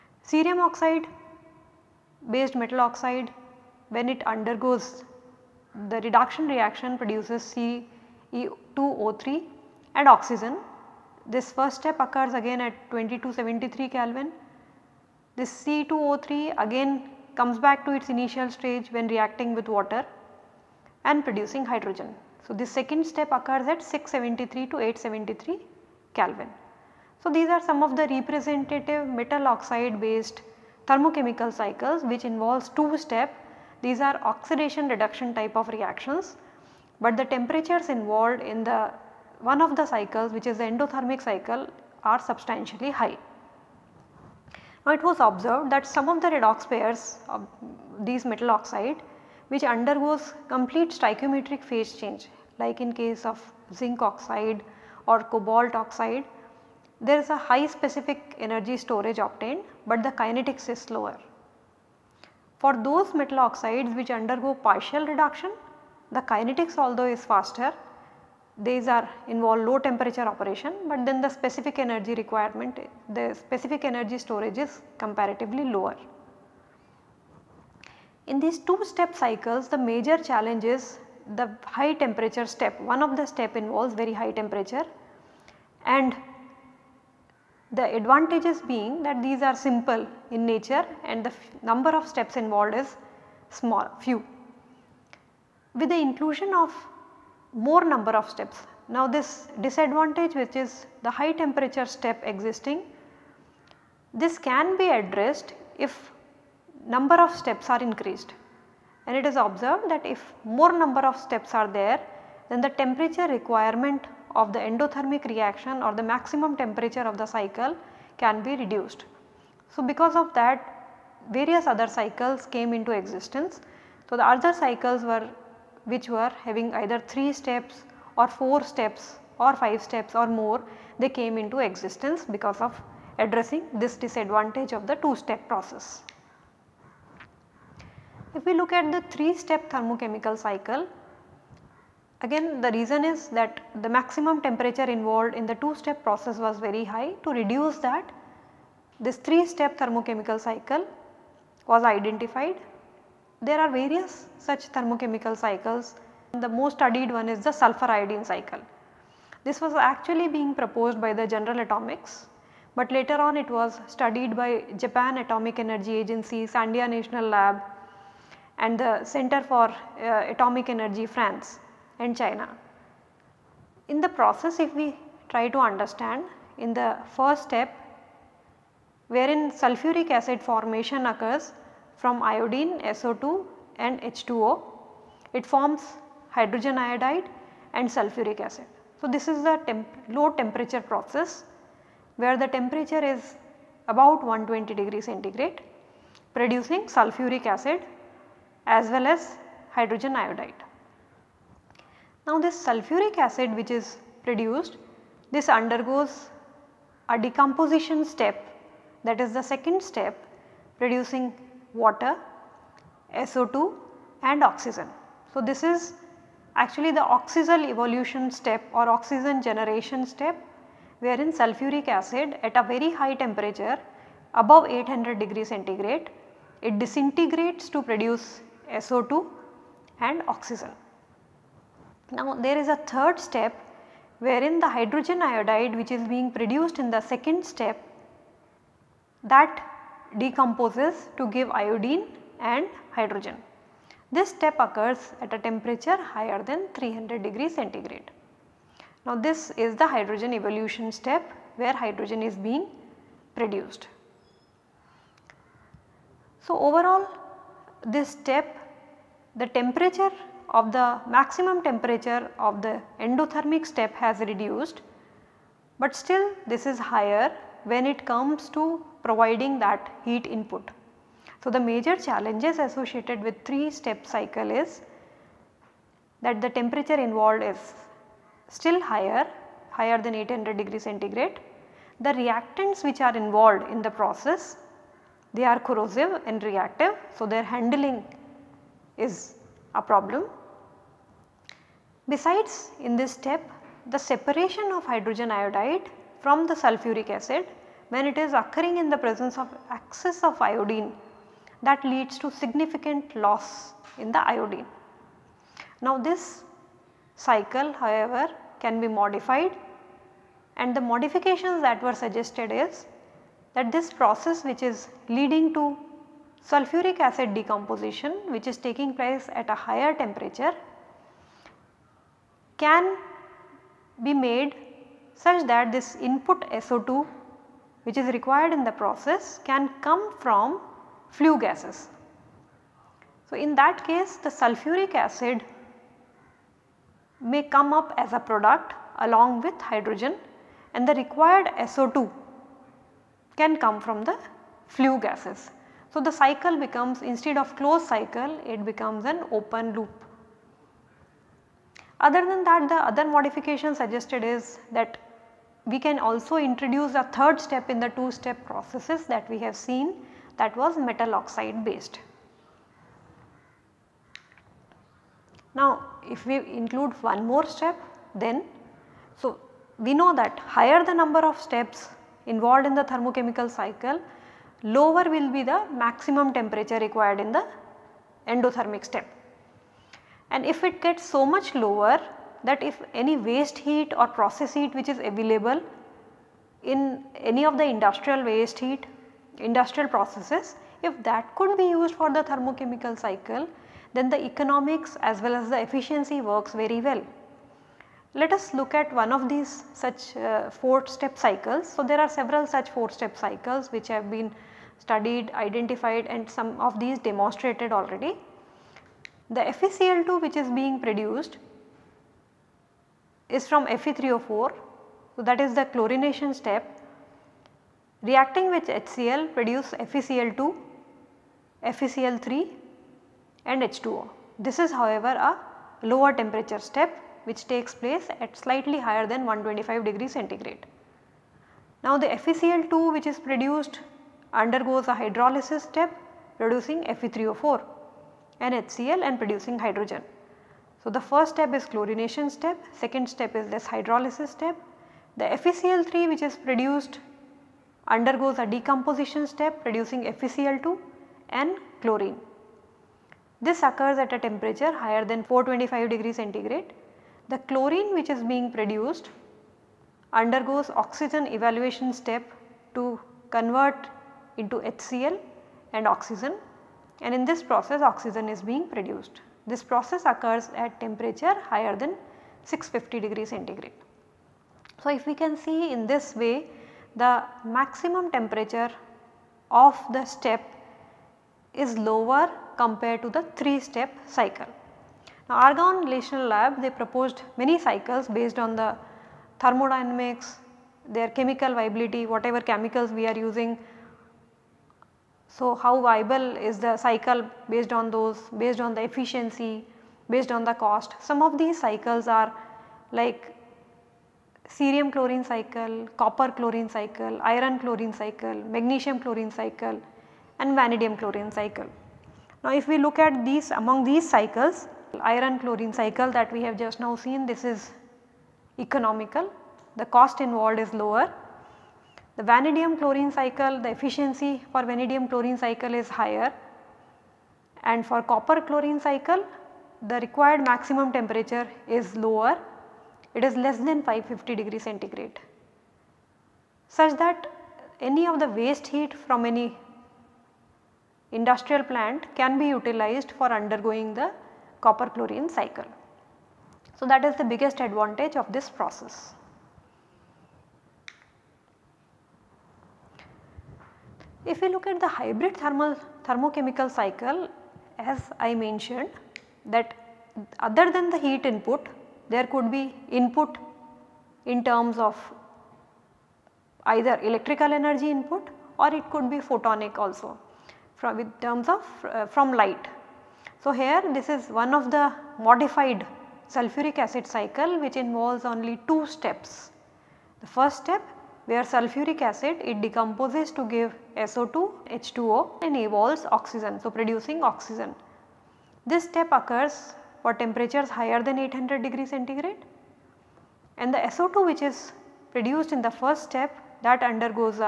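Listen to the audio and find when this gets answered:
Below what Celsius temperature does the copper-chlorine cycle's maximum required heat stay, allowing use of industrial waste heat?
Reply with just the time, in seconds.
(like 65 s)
533 s.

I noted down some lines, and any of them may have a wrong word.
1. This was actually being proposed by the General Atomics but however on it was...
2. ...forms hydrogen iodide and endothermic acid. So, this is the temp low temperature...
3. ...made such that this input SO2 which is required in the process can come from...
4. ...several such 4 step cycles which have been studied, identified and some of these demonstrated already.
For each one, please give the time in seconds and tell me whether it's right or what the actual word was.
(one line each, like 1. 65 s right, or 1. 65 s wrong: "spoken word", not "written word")
1. 159 s wrong: "later", not "however"
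2. 185 s wrong: "sulfuric", not "endothermic"
3. 324 s right
4. 402 s right.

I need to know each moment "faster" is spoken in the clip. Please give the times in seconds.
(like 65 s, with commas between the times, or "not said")
67 s.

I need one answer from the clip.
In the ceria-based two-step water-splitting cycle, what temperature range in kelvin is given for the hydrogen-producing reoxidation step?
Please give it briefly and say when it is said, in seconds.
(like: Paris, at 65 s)
673 to 873 K, at 23 s.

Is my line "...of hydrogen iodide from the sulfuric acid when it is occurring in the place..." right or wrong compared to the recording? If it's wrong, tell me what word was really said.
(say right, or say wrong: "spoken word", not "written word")
wrong: "presence", not "place".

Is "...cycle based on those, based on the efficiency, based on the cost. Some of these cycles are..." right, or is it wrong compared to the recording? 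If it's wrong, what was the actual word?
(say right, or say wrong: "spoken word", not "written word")
right.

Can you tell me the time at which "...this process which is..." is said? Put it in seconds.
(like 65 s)
313 s.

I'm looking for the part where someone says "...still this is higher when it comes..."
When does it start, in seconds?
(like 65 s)
265 s.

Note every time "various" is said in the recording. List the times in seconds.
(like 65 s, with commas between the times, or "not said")
121 s, 153 s.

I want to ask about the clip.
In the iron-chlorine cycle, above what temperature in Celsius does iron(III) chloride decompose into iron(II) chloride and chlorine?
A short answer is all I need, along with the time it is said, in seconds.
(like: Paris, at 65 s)
425 degrees C, at 455 s.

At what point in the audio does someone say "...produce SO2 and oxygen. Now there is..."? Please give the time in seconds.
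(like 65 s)
227 s.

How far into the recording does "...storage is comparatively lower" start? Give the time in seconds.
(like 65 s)
74 s.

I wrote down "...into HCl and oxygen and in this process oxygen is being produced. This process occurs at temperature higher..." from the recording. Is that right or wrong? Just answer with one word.
right.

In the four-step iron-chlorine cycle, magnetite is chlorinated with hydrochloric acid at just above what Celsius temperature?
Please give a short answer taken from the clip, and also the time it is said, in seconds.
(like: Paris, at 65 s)
125 degrees C, at 429 s.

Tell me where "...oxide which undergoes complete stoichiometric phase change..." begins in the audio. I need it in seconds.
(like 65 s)
48 s.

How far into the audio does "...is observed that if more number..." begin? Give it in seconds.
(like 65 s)
109 s.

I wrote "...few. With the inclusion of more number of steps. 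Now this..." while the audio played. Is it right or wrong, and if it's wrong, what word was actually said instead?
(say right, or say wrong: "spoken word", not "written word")
right.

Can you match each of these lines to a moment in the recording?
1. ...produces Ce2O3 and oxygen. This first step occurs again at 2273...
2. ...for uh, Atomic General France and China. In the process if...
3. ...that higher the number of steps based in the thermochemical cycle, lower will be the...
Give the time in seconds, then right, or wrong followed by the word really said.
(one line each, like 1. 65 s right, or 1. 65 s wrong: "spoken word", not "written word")
1. 6 s right
2. 169 s wrong: "Energy", not "General"
3. 370 s wrong: "involved", not "based".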